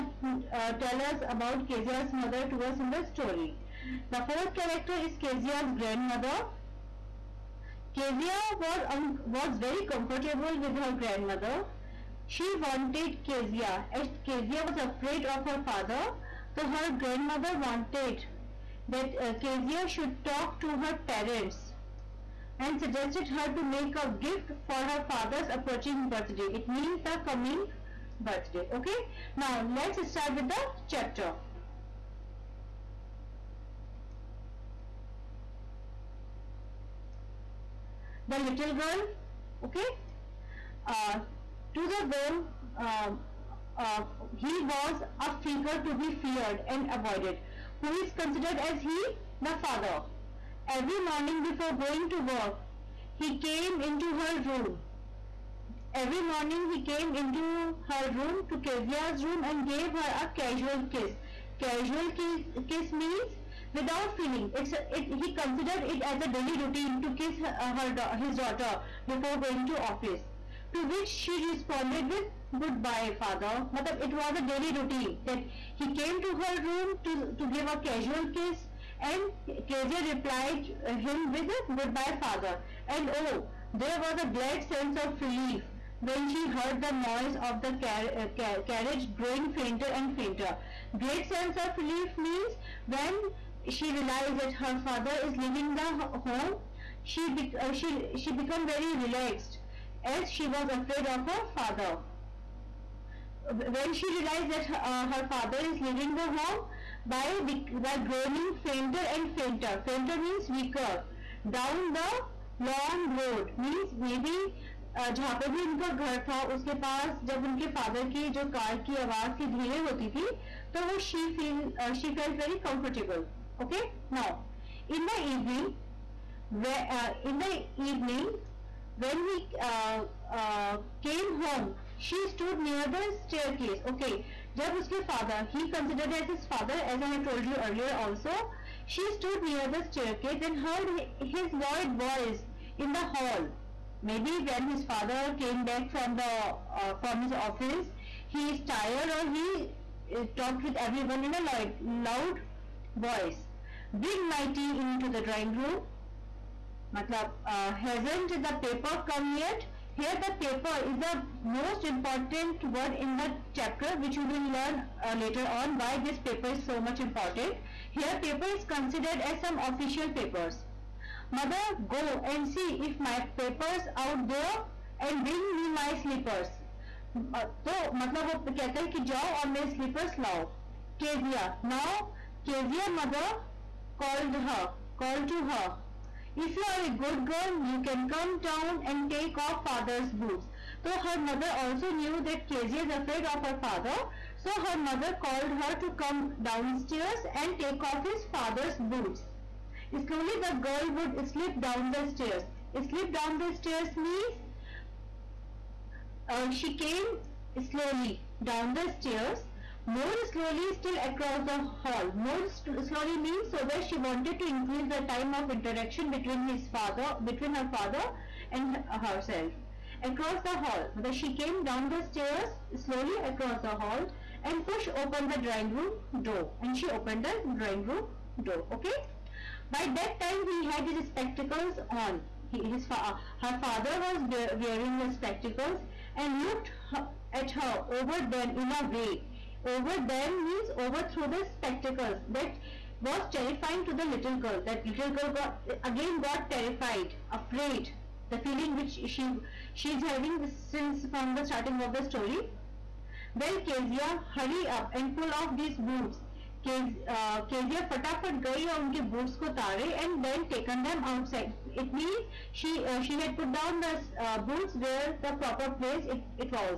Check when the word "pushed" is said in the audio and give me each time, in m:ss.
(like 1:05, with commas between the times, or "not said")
3:44.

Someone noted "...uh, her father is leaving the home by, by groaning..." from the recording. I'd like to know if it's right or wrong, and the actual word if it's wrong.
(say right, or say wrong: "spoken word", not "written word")
right.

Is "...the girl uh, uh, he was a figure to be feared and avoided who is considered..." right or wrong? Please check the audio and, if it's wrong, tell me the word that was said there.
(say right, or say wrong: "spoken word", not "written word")
right.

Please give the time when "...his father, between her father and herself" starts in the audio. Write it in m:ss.
3:36.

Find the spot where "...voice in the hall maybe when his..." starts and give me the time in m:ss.
2:21.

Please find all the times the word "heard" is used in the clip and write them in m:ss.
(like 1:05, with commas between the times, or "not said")
1:26, 2:20.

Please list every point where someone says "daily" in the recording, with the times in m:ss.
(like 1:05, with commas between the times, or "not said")
1:06, 1:14.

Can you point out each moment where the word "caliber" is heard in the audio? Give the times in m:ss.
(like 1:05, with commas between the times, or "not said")
not said.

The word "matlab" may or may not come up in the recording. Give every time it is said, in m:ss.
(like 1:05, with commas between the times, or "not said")
1:13, 2:36.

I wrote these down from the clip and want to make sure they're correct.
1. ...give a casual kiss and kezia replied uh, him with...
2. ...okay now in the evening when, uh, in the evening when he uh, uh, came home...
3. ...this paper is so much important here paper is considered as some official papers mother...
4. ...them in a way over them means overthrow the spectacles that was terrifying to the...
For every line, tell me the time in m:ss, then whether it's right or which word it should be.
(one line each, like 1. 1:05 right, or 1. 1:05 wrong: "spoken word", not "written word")
1. 1:17 right
2. 2:03 right
3. 2:45 right
4. 3:58 right.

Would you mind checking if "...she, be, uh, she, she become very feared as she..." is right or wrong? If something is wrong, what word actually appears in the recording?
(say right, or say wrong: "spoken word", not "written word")
wrong: "relaxed", not "feared".